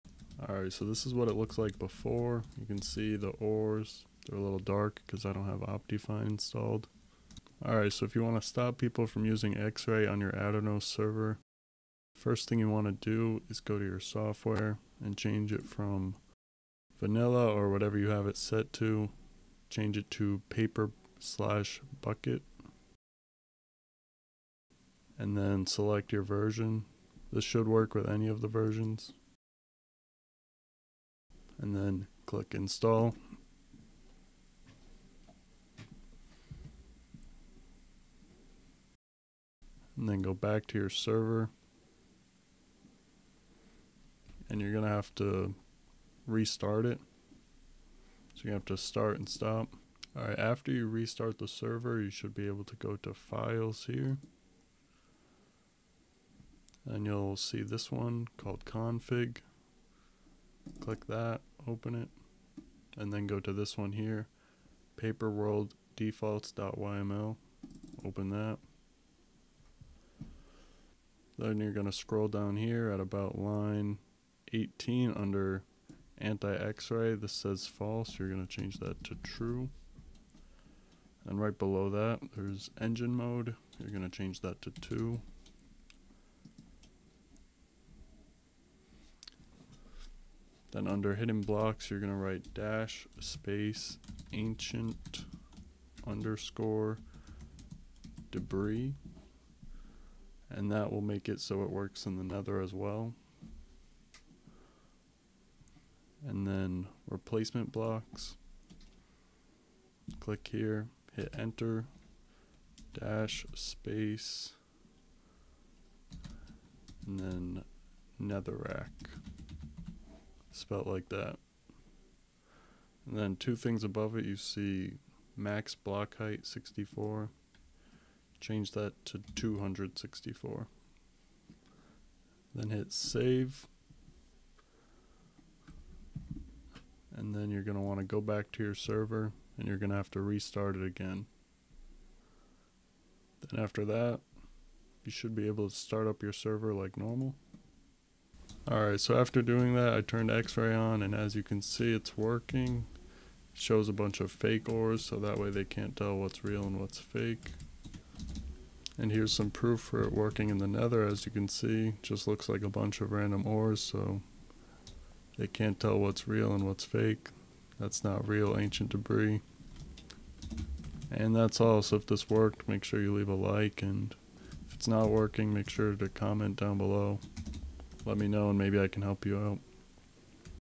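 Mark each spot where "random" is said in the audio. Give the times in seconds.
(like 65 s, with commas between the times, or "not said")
163 s.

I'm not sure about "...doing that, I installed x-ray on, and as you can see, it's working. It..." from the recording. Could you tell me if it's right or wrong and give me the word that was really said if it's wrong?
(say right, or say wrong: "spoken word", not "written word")
wrong: "turned", not "installed".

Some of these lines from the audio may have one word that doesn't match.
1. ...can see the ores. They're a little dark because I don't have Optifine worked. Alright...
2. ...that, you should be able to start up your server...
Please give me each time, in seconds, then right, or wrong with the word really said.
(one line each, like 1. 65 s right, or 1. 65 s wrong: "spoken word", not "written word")
1. 2 s wrong: "installed", not "worked"
2. 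143 s right.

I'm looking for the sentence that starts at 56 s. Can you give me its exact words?
And you'll see this one called config.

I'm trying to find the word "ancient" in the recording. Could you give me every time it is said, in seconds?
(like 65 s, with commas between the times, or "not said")
94 s, 168 s.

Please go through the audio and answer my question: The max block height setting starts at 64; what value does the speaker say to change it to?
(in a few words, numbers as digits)
264.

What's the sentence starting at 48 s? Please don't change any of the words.
So you have to start and stop.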